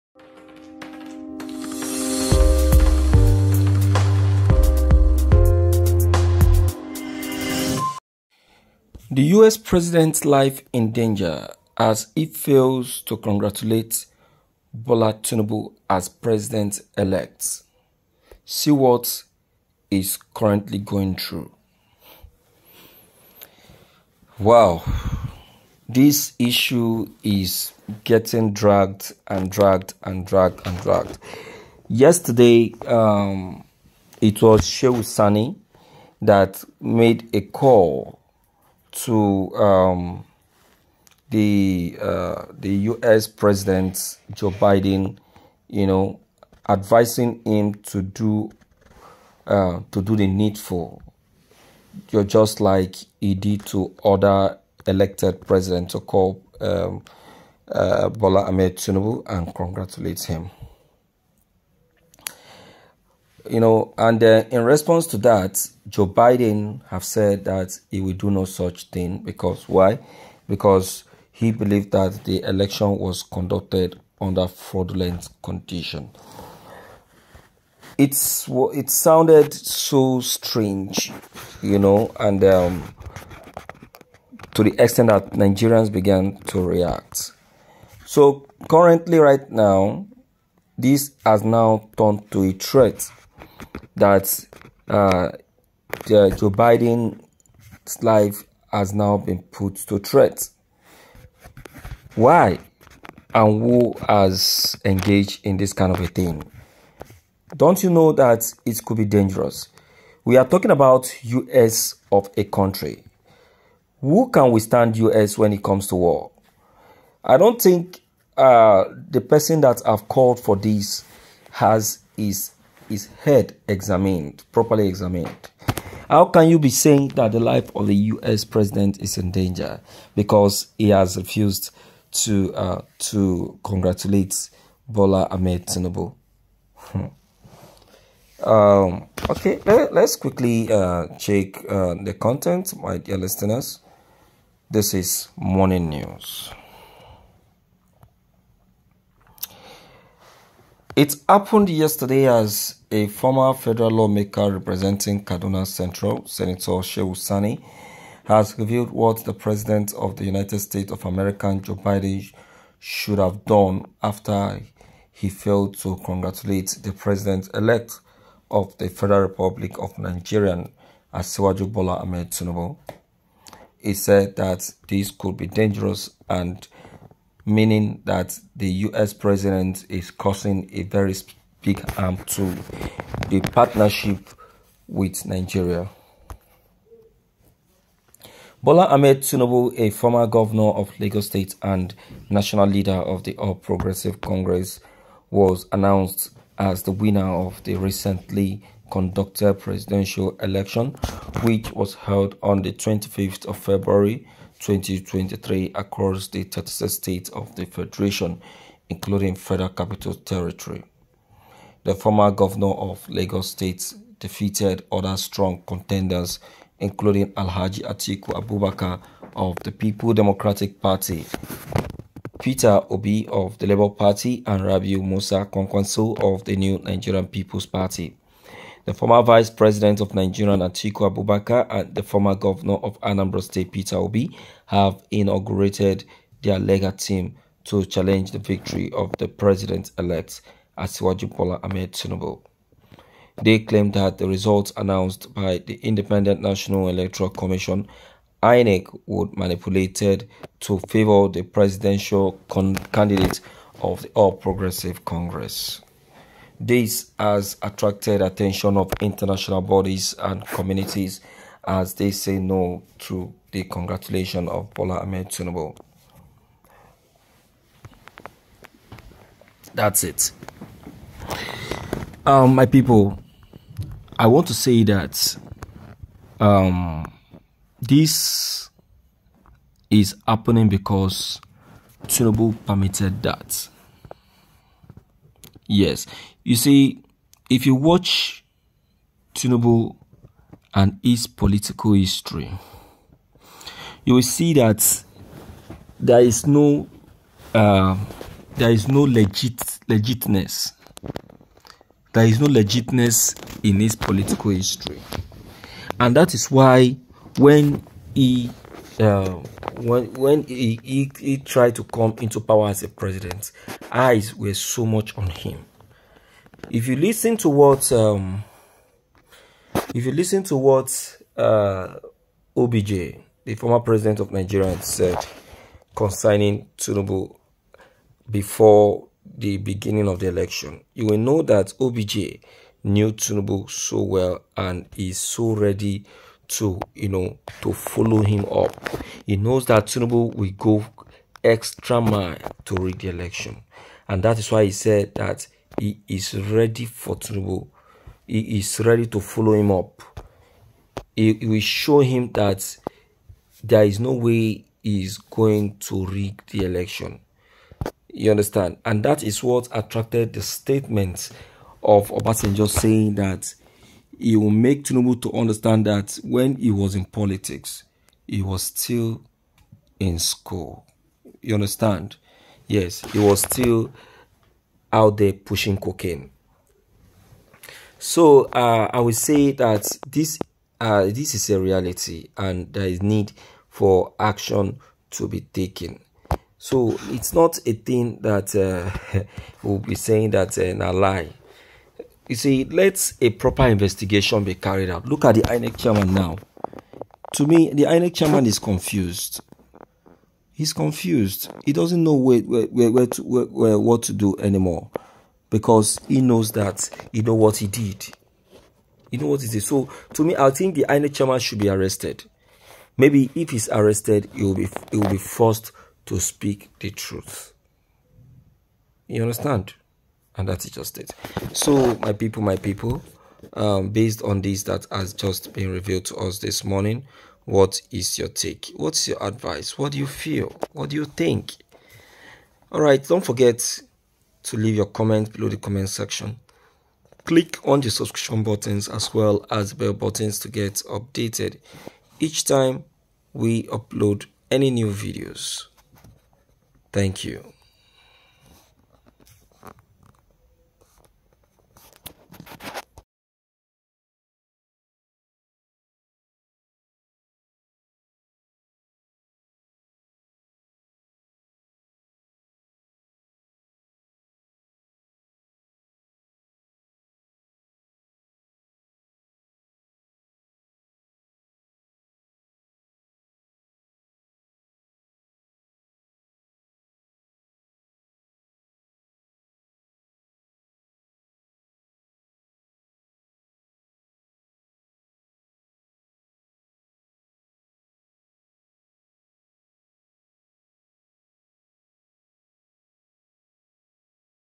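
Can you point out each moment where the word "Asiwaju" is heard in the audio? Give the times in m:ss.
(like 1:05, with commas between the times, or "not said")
2:51, 4:00.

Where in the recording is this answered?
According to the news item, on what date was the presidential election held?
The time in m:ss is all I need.
3:22.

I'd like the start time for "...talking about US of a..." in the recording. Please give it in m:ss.
1:50.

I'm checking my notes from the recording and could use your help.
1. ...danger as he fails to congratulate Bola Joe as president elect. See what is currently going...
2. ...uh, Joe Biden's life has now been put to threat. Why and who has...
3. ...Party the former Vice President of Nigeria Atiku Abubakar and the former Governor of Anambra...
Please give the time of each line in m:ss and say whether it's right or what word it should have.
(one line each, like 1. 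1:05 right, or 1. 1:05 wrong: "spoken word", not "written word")
1. 0:10 wrong: "Tinubu", not "Joe"
2. 1:34 right
3. 3:47 right.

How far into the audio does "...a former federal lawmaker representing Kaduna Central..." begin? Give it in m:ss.
2:32.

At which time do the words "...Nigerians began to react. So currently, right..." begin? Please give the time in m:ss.
1:25.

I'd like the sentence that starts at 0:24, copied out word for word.
Wow, this issue is getting dragged and dragged and dragged and dragged.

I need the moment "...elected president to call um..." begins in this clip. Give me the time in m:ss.
0:54.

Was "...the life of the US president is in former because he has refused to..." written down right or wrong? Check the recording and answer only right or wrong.
wrong.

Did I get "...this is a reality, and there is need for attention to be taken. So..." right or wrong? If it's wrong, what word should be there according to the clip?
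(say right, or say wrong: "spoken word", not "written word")
wrong: "action", not "attention".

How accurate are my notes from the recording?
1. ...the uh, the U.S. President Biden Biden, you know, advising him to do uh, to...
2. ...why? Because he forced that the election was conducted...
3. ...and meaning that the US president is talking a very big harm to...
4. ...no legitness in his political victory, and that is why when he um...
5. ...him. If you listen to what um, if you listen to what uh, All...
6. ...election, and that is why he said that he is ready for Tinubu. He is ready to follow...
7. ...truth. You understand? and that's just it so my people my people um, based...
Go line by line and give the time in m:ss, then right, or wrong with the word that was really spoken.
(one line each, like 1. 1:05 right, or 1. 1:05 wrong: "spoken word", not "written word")
1. 0:41 wrong: "Joe", not "Biden"
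2. 1:09 wrong: "believed", not "forced"
3. 2:56 wrong: "causing", not "talking"
4. 5:02 wrong: "history", not "victory"
5. 5:15 wrong: "OBJ", not "All"
6. 5:43 right
7. 6:56 right.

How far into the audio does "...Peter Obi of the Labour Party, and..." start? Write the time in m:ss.
3:42.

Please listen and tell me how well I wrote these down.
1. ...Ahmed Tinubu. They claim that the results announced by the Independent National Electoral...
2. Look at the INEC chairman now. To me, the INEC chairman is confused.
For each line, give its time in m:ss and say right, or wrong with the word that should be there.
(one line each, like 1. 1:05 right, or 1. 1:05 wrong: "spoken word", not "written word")
1. 4:01 right
2. 6:35 right.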